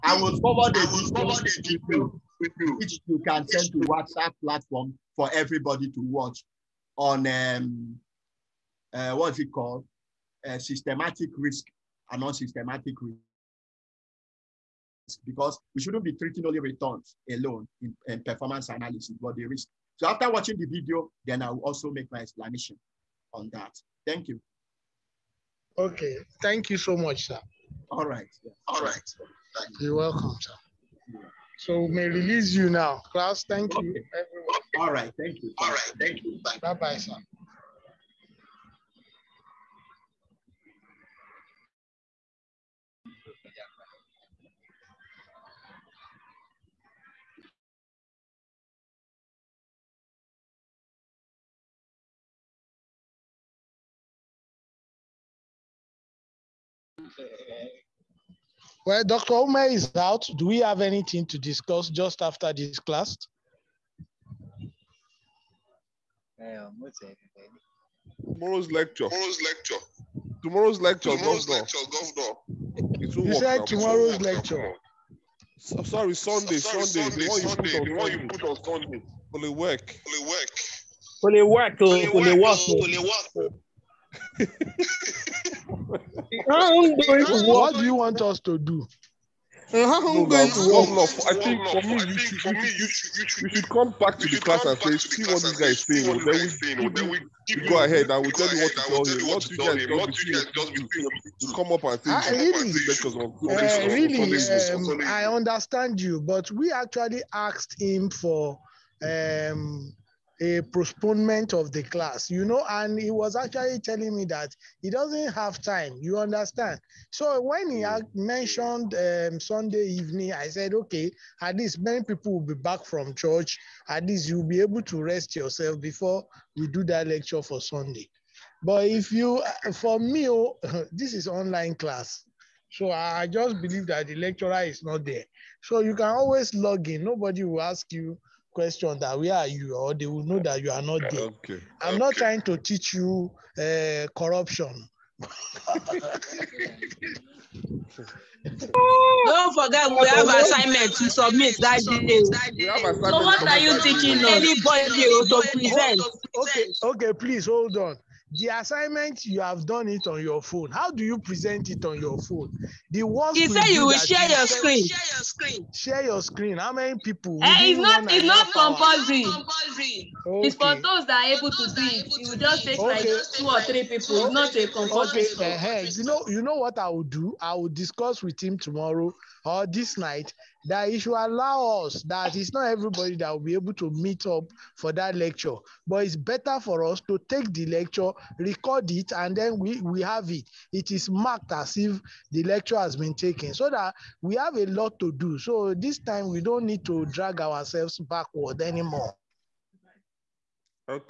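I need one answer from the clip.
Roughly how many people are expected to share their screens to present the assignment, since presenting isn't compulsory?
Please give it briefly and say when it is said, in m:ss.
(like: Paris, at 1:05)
2 or 3, at 2:53.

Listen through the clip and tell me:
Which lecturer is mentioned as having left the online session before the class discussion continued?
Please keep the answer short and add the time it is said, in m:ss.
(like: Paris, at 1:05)
Dr. Umeh, at 0:59.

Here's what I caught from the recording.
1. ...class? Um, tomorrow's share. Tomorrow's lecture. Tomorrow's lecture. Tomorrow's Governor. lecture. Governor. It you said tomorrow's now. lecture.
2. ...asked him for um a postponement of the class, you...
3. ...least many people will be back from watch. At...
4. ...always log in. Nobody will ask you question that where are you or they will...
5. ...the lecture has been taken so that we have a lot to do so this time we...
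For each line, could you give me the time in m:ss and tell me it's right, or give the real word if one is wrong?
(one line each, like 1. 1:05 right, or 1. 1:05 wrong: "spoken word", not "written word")
1. 1:02 wrong: "lecture", not "share"
2. 1:47 right
3. 2:01 wrong: "church", not "watch"
4. 2:16 right
5. 3:12 right.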